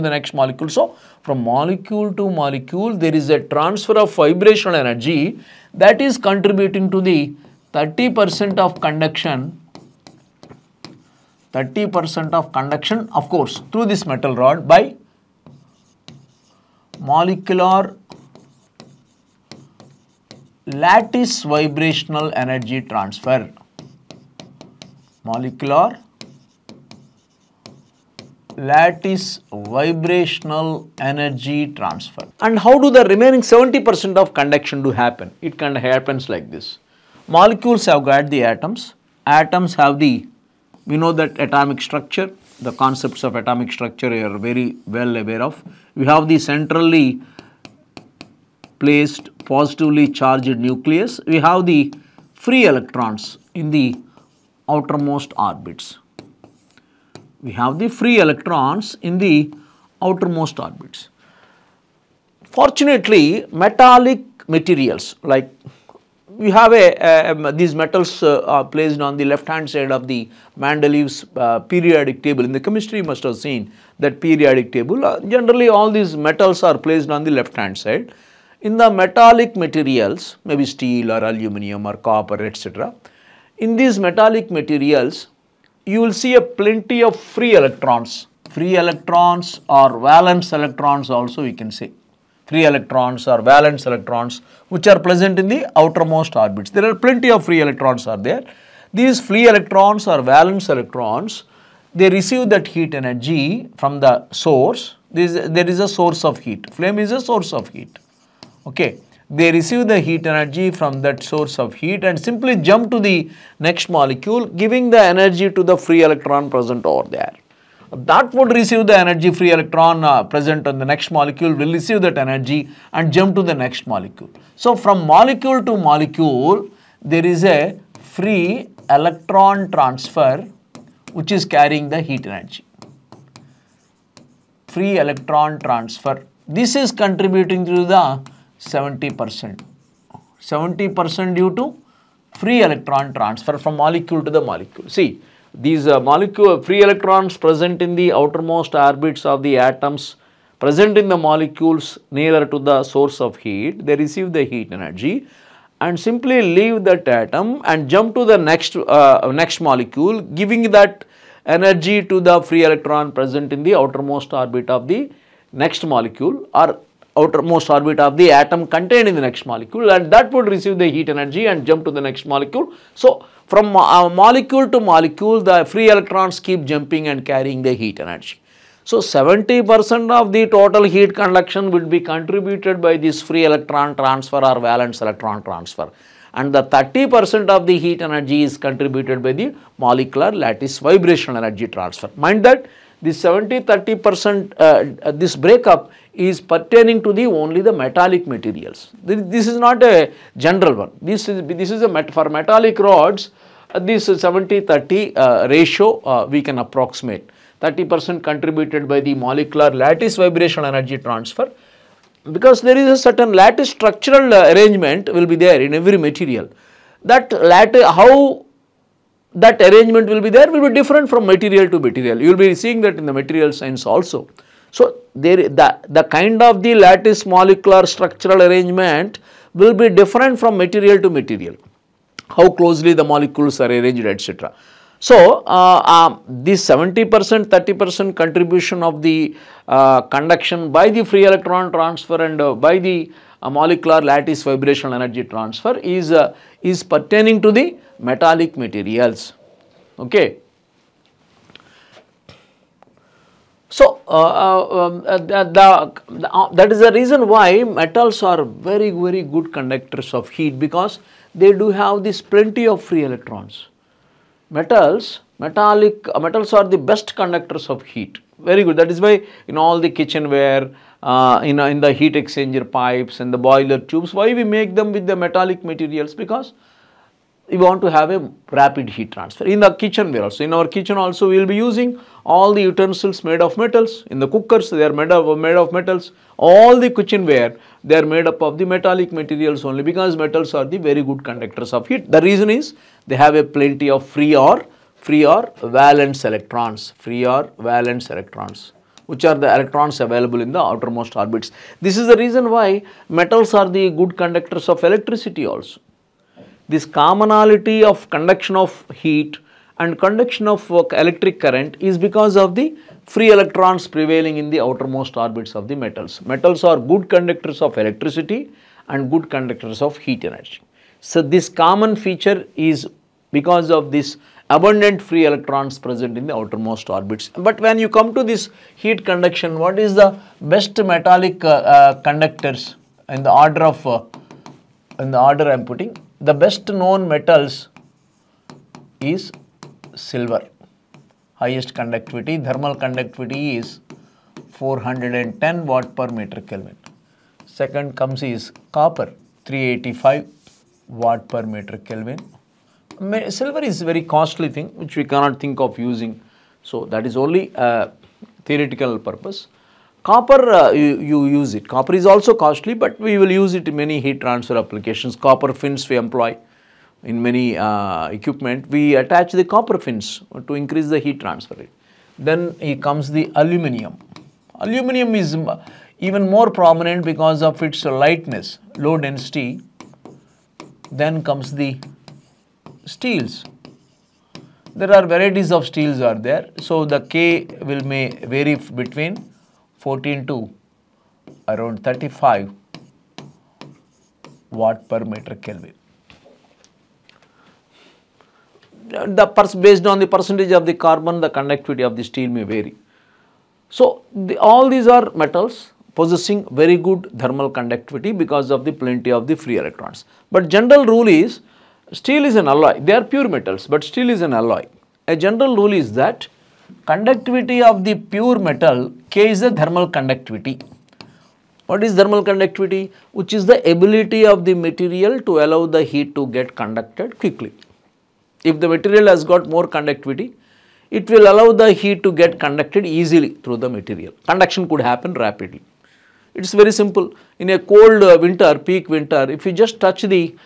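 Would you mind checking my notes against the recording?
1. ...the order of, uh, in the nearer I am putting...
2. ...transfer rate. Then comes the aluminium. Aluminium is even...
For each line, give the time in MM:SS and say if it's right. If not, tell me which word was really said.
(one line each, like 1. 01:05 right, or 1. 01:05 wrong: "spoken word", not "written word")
1. 05:33 wrong: "order", not "nearer"
2. 06:11 right.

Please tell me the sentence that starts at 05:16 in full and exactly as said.
Metals are good conductors of electricity and good conductors of heat energy.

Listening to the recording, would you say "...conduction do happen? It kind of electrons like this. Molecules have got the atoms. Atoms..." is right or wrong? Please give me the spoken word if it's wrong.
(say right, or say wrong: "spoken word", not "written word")
wrong: "happens", not "electrons".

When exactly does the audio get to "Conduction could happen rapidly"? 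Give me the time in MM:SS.
07:14.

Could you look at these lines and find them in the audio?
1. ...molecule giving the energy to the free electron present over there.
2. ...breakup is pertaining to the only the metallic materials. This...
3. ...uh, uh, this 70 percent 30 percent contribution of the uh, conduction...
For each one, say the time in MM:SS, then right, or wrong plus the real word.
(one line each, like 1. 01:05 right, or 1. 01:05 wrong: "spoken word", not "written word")
1. 01:53 right
2. 03:15 right
3. 03:55 right.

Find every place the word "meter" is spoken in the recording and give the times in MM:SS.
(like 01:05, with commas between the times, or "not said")
05:46, 05:51, 06:35.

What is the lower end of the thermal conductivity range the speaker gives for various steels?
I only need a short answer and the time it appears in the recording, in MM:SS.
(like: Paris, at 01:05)
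14, at 06:29.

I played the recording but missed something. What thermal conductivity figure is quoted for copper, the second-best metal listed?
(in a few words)
385 W/m·K.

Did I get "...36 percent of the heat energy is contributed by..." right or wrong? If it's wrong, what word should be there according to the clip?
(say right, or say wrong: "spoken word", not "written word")
wrong: "30", not "36".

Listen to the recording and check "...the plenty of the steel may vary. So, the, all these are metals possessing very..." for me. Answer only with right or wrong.
wrong.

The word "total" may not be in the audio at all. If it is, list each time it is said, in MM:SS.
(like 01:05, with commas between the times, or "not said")
03:00.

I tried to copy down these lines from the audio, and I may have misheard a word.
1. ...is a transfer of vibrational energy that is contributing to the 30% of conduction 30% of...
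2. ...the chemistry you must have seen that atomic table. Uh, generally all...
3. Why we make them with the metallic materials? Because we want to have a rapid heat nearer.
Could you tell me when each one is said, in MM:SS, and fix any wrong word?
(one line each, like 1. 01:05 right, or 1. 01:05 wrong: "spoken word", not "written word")
1. 00:03 right
2. 01:12 wrong: "periodic", not "atomic"
3. 04:34 wrong: "transfer", not "nearer".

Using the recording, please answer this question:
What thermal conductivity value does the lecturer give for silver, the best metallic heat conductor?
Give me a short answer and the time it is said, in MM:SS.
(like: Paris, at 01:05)
410 W/m·K, at 05:44.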